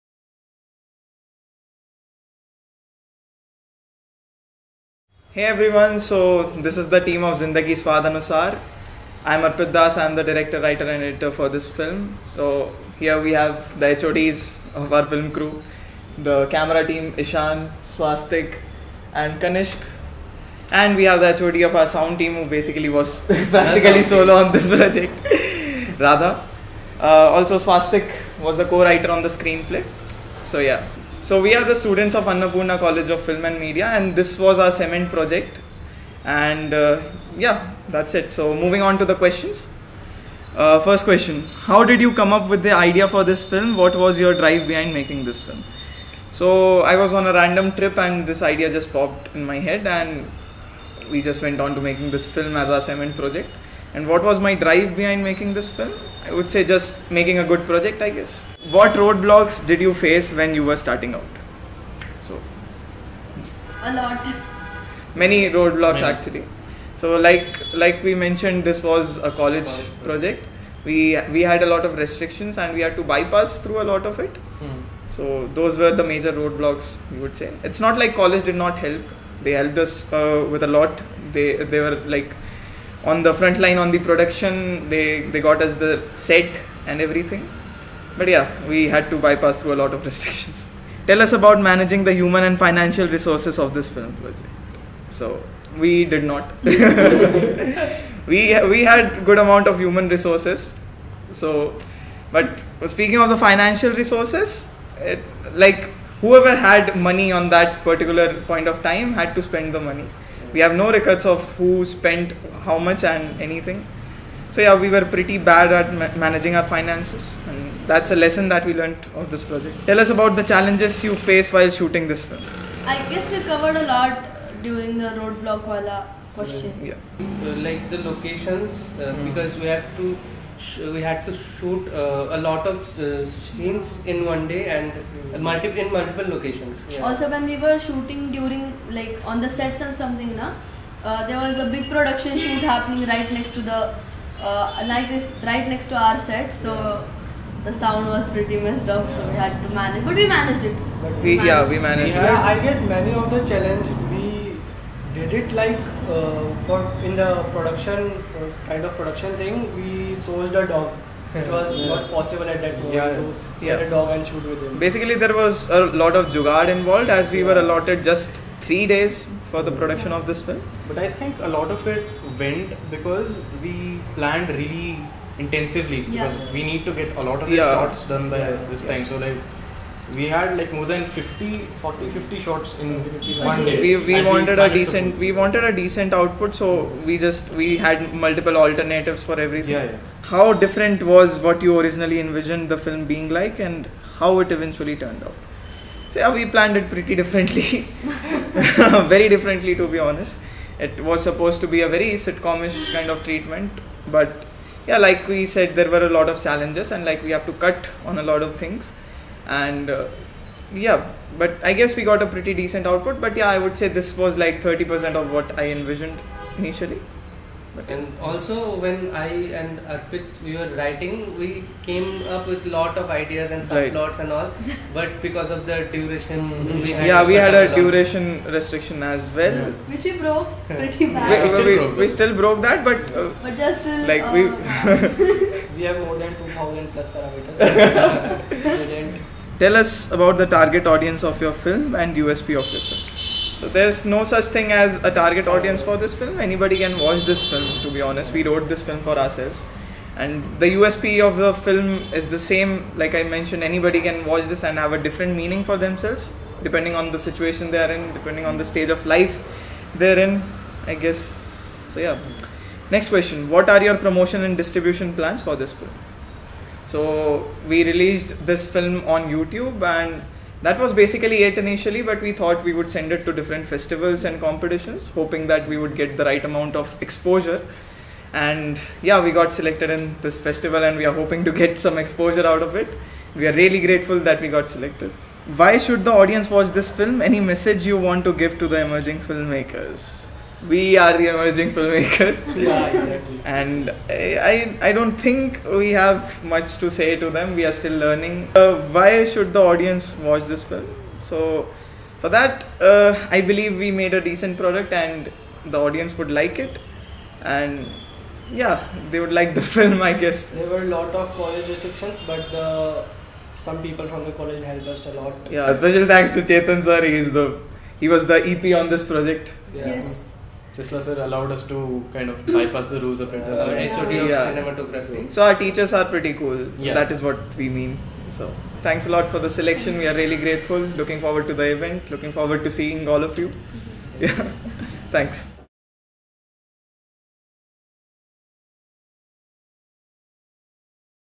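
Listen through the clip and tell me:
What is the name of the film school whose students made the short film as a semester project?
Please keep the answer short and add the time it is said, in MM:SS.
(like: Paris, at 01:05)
Annapurna College of Film and Media, at 00:32.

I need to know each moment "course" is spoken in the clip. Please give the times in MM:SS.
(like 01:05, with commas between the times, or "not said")
not said.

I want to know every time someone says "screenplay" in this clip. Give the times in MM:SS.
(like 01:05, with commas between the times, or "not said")
00:29.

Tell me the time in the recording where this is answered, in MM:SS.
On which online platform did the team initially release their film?
04:29.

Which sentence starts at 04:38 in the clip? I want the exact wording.
And yeah, we got selected in this festival and we are hoping to get some exposure out of it.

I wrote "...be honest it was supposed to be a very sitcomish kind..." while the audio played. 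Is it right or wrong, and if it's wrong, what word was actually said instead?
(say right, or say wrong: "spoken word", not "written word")
right.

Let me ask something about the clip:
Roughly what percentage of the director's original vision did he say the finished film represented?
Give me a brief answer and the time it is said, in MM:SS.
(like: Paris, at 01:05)
30%, at 03:34.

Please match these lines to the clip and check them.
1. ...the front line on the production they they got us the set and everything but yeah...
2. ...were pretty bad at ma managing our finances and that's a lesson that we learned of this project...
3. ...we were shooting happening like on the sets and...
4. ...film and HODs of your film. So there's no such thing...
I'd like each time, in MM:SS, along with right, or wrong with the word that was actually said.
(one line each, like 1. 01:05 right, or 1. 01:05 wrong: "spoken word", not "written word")
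1. 01:23 right
2. 01:54 right
3. 02:17 wrong: "during", not "happening"
4. 04:01 wrong: "USP", not "HODs".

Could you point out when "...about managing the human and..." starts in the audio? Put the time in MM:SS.
01:31.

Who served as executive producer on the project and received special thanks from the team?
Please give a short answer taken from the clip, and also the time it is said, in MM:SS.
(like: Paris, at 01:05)
Chetan, at 05:16.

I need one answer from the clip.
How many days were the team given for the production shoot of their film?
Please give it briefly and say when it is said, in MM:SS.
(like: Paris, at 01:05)
3, at 02:48.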